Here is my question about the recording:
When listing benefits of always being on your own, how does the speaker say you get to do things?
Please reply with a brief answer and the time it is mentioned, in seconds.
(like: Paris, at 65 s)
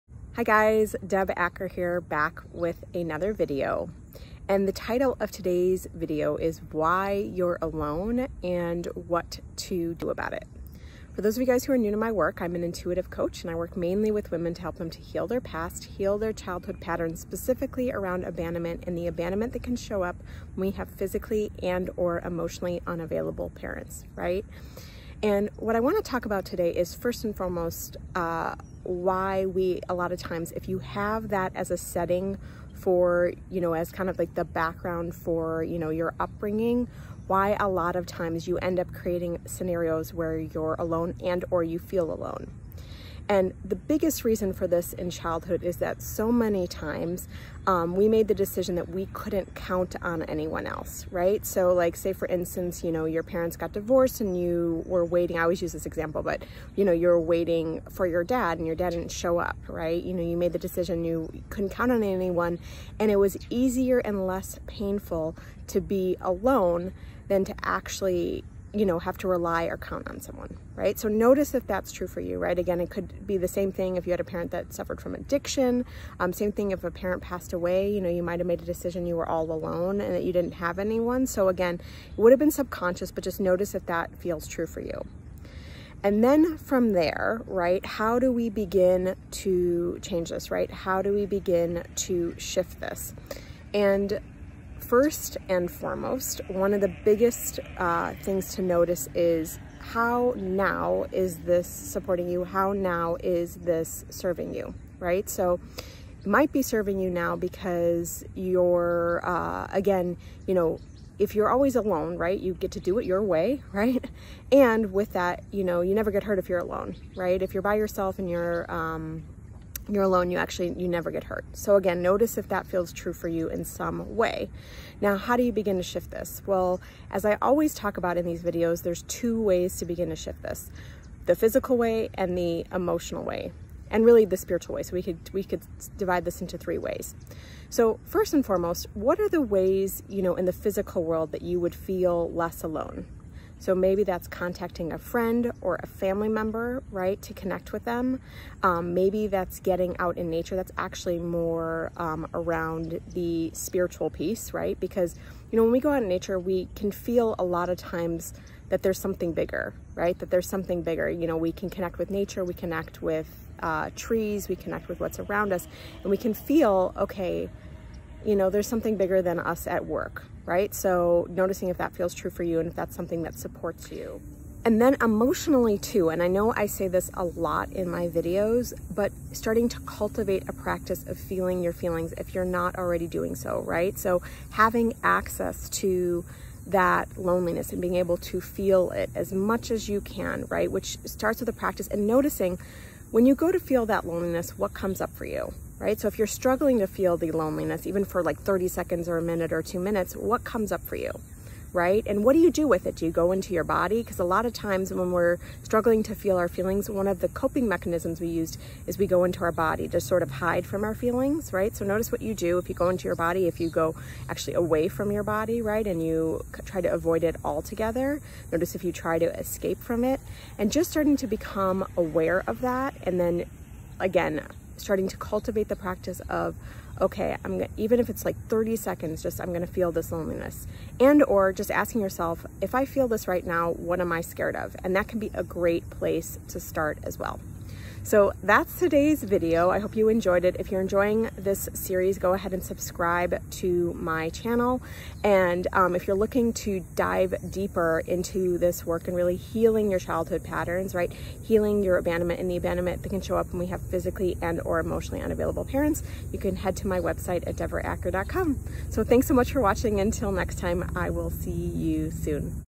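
your way, at 113 s.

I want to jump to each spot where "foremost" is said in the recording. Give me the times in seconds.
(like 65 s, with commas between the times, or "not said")
27 s, 95 s, 138 s.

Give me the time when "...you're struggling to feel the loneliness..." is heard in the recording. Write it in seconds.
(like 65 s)
196 s.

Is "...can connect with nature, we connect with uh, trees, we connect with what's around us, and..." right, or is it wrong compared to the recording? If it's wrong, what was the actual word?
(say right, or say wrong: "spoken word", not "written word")
right.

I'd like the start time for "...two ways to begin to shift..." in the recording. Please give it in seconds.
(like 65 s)
129 s.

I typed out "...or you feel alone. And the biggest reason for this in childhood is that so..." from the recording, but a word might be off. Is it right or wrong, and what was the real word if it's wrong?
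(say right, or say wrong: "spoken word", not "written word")
right.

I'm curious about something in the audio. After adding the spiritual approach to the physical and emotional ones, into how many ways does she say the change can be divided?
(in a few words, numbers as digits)
3.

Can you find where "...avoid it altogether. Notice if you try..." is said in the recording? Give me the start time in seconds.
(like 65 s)
216 s.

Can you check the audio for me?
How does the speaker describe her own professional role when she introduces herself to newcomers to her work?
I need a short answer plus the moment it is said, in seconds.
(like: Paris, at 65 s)
intuitive coach, at 12 s.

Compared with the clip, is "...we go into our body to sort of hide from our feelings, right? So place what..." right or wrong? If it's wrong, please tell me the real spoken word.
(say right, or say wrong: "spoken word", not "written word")
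wrong: "notice", not "place".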